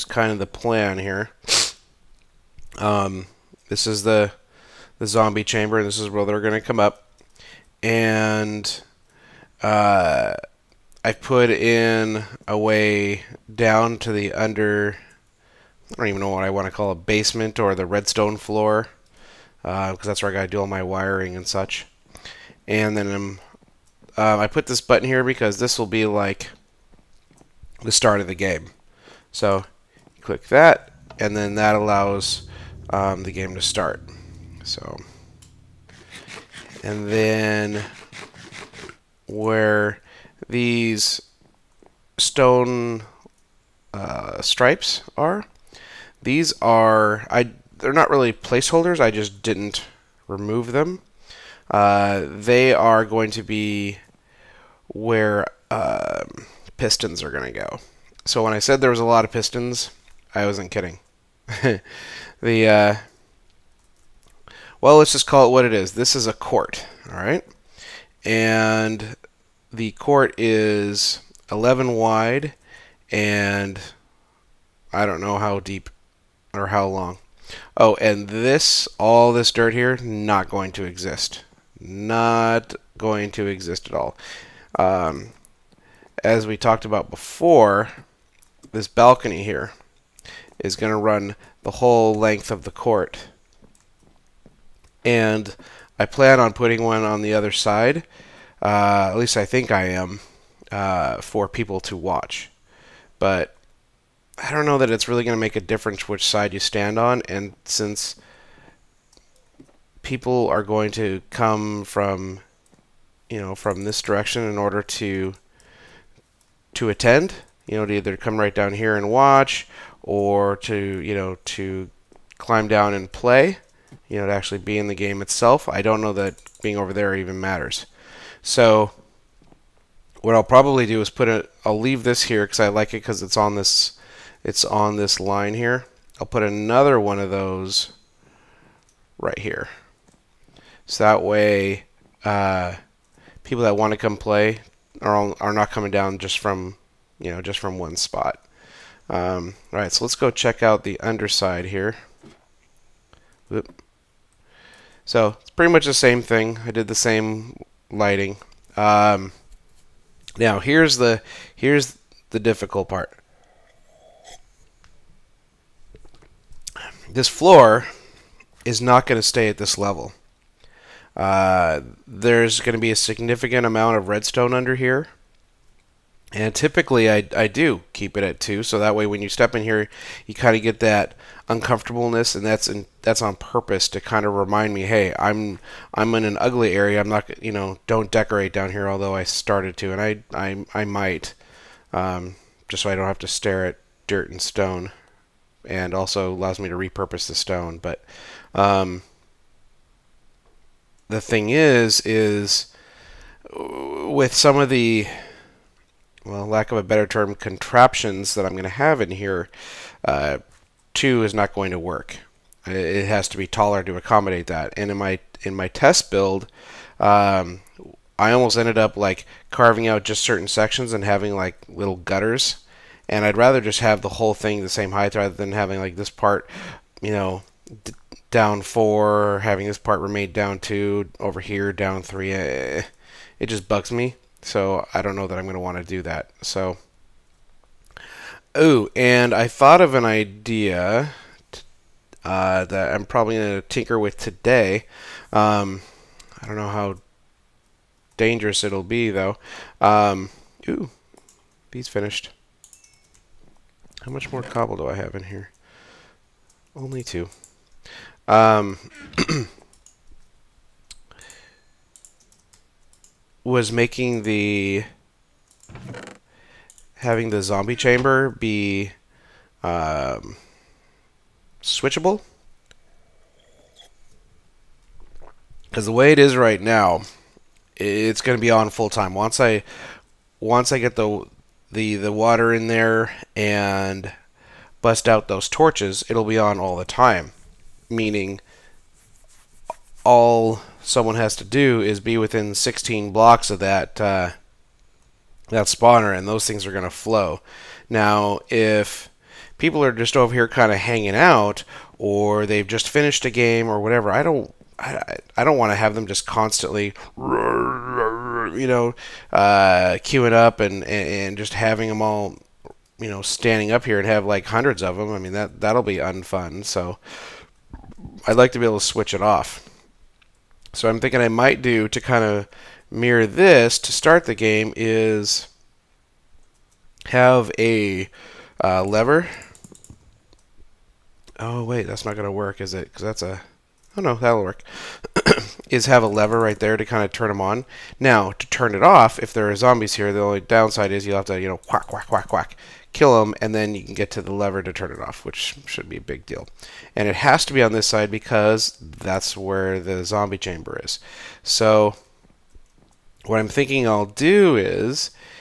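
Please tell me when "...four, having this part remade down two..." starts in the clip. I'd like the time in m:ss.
3:48.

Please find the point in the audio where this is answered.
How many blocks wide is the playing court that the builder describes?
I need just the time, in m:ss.
1:11.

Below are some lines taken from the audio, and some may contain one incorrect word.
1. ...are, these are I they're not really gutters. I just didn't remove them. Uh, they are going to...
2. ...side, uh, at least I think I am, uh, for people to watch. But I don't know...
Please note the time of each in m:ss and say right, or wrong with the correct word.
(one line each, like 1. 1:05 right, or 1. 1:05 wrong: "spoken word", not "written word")
1. 0:45 wrong: "placeholders", not "gutters"
2. 1:37 right.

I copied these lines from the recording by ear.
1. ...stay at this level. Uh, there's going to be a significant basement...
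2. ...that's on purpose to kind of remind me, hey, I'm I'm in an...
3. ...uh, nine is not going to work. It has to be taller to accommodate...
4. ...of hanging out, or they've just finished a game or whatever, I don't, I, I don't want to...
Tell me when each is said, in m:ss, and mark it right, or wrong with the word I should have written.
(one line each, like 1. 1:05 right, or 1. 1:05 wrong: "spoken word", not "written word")
1. 2:49 wrong: "amount", not "basement"
2. 3:03 right
3. 3:30 wrong: "two", not "nine"
4. 5:00 right.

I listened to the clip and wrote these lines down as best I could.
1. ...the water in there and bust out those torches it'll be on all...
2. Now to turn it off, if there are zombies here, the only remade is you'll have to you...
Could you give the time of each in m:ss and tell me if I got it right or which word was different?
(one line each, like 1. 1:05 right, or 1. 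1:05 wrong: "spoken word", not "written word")
1. 4:41 right
2. 5:37 wrong: "downside", not "remade".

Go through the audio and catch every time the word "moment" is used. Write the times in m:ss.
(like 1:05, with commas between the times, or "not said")
not said.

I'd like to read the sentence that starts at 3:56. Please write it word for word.
So, ooh, and I thought of an idea uh, that I'm probably going to tinker with today.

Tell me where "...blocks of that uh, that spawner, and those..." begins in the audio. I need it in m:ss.
4:53.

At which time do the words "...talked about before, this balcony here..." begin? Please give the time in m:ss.
1:26.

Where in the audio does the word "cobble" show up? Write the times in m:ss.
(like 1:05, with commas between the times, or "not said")
4:14.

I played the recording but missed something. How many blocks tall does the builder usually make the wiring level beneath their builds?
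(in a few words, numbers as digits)
2.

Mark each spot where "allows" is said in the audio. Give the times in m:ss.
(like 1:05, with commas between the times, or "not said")
0:31, 3:16.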